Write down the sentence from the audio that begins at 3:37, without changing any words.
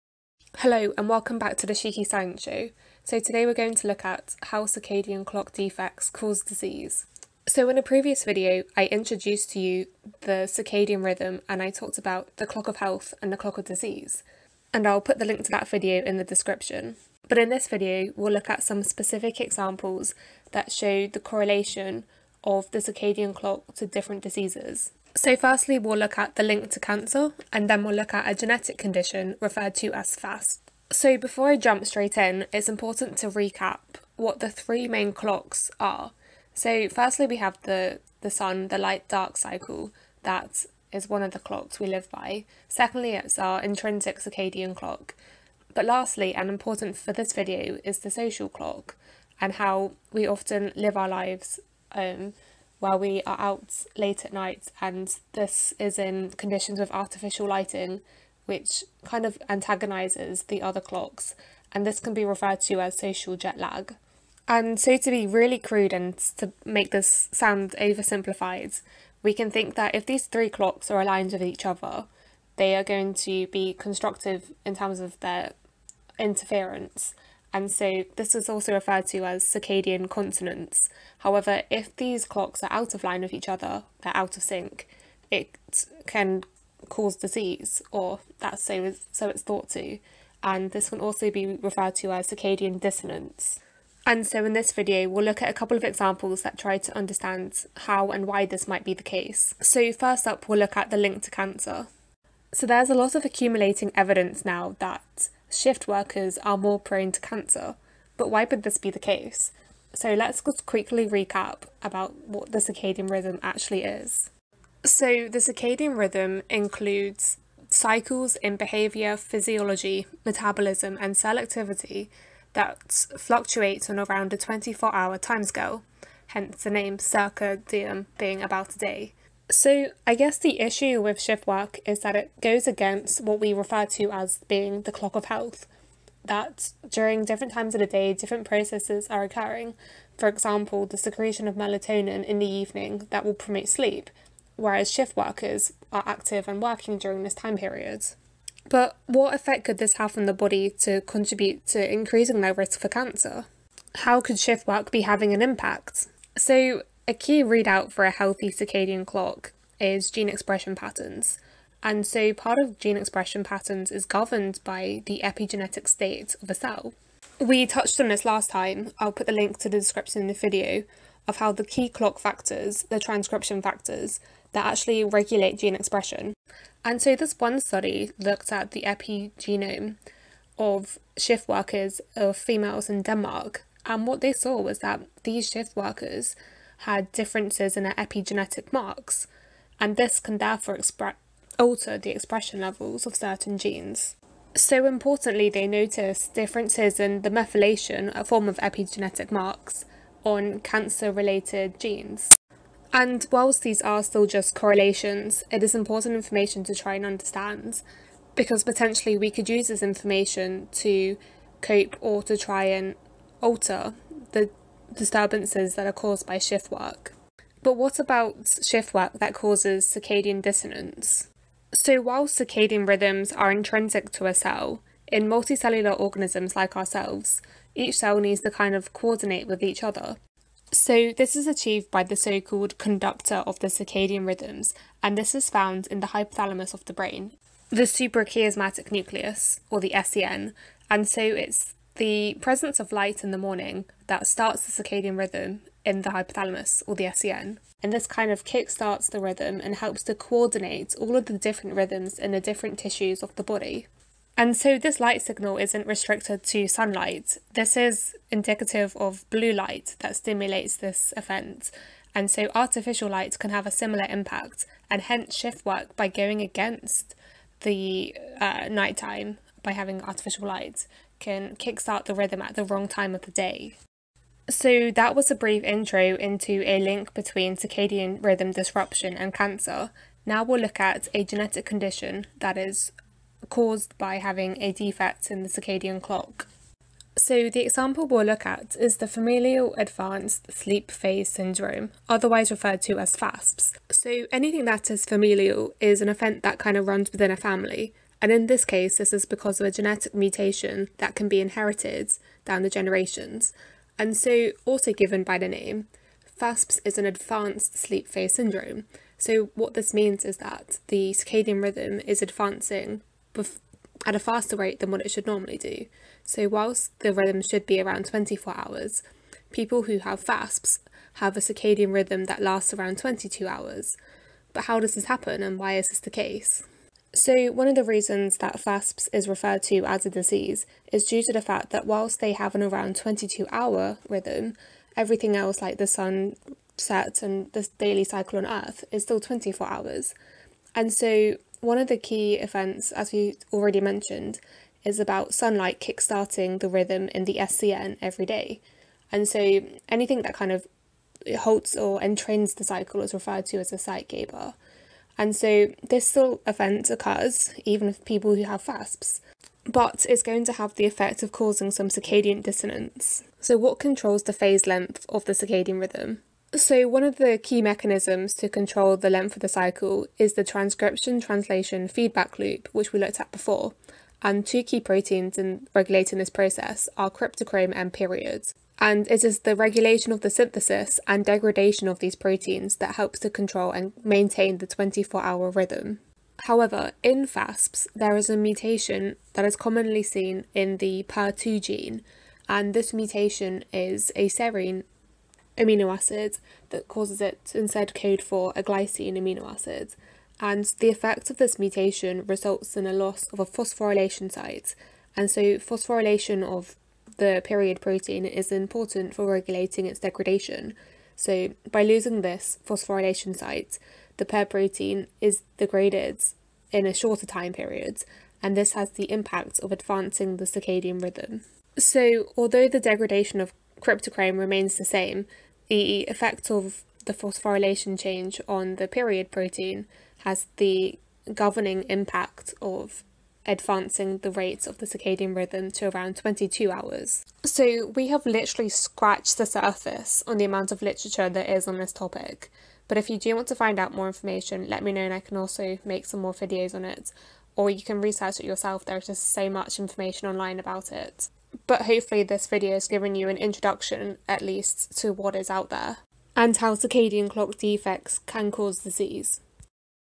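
But what about shift work that causes circadian dissonance?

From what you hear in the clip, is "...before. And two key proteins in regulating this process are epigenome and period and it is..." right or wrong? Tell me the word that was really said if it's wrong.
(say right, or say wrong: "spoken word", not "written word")
wrong: "cryptochrome", not "epigenome".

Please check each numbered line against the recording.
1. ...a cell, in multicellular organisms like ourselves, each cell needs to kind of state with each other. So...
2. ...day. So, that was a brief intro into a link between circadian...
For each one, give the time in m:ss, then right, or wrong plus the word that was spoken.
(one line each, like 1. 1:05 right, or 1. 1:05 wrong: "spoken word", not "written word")
1. 3:44 wrong: "coordinate", not "state"
2. 4:33 right.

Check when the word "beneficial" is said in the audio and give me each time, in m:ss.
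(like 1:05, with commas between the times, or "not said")
not said.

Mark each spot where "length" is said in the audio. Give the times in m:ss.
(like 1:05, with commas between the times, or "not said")
6:04, 6:09.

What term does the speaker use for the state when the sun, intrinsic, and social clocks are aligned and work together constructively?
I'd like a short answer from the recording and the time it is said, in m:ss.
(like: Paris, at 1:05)
circadian consonance, at 1:19.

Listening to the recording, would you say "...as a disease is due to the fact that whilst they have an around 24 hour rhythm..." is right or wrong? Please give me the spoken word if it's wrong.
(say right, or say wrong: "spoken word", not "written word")
wrong: "22", not "24".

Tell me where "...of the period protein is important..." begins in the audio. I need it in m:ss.
6:46.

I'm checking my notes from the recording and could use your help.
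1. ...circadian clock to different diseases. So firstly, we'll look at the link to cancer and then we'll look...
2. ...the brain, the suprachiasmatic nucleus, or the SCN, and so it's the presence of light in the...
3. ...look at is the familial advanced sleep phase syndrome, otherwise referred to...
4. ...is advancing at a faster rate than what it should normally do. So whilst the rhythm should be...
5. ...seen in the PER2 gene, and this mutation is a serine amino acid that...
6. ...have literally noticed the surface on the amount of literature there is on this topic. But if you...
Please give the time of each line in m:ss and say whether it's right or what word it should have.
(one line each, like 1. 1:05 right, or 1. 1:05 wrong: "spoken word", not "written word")
1. 0:22 right
2. 3:56 right
3. 4:48 right
4. 5:12 right
5. 6:30 right
6. 7:18 wrong: "scratched", not "noticed".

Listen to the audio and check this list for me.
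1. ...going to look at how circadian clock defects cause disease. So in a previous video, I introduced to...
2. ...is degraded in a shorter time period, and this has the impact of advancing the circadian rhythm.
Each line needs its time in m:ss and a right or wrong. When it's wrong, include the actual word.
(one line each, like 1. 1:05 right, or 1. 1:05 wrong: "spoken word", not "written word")
1. 0:03 right
2. 6:55 right.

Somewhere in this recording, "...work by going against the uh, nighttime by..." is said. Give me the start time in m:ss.
4:25.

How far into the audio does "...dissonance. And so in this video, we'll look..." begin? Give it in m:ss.
1:32.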